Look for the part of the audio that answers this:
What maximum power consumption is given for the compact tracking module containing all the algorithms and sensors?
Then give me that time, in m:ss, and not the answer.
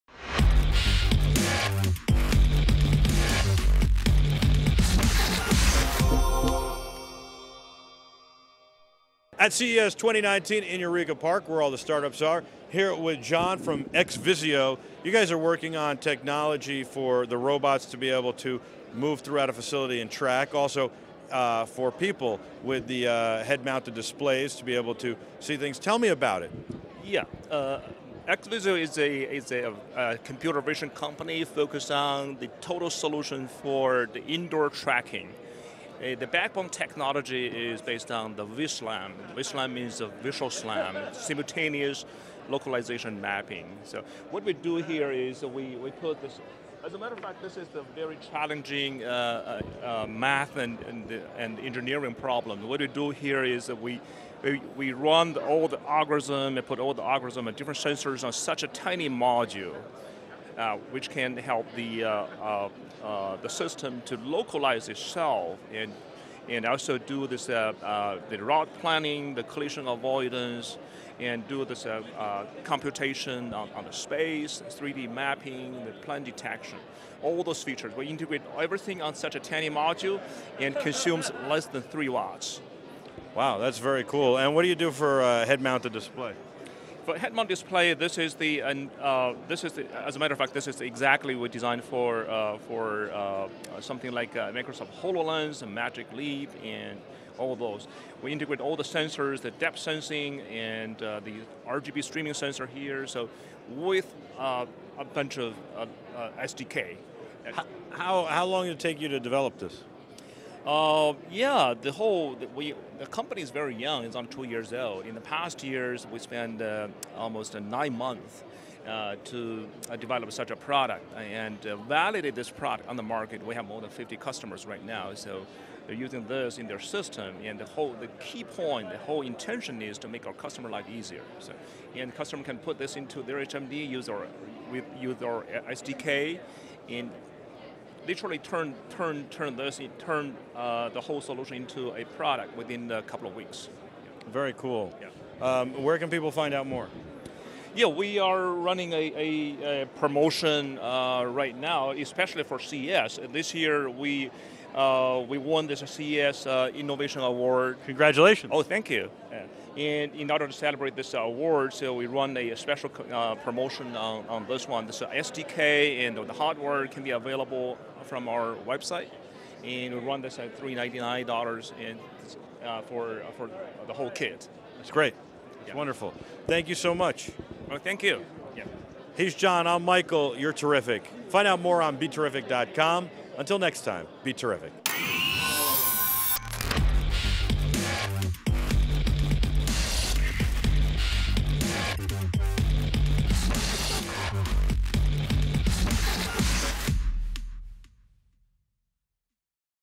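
1:21.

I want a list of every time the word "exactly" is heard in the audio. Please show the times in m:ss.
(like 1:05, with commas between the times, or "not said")
1:30.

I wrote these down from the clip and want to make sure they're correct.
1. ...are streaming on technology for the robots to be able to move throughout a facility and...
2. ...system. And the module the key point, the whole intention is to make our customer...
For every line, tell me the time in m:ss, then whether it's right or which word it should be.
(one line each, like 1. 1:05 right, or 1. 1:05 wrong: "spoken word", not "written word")
1. 0:15 wrong: "working", not "streaming"
2. 2:06 wrong: "whole", not "module".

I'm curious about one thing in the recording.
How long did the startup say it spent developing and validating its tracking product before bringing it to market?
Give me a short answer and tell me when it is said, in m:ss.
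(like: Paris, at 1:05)
almost 9 months, at 1:57.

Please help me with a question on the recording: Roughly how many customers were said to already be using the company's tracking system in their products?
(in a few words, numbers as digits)
more than 50.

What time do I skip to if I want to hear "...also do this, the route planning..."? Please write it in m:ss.
1:06.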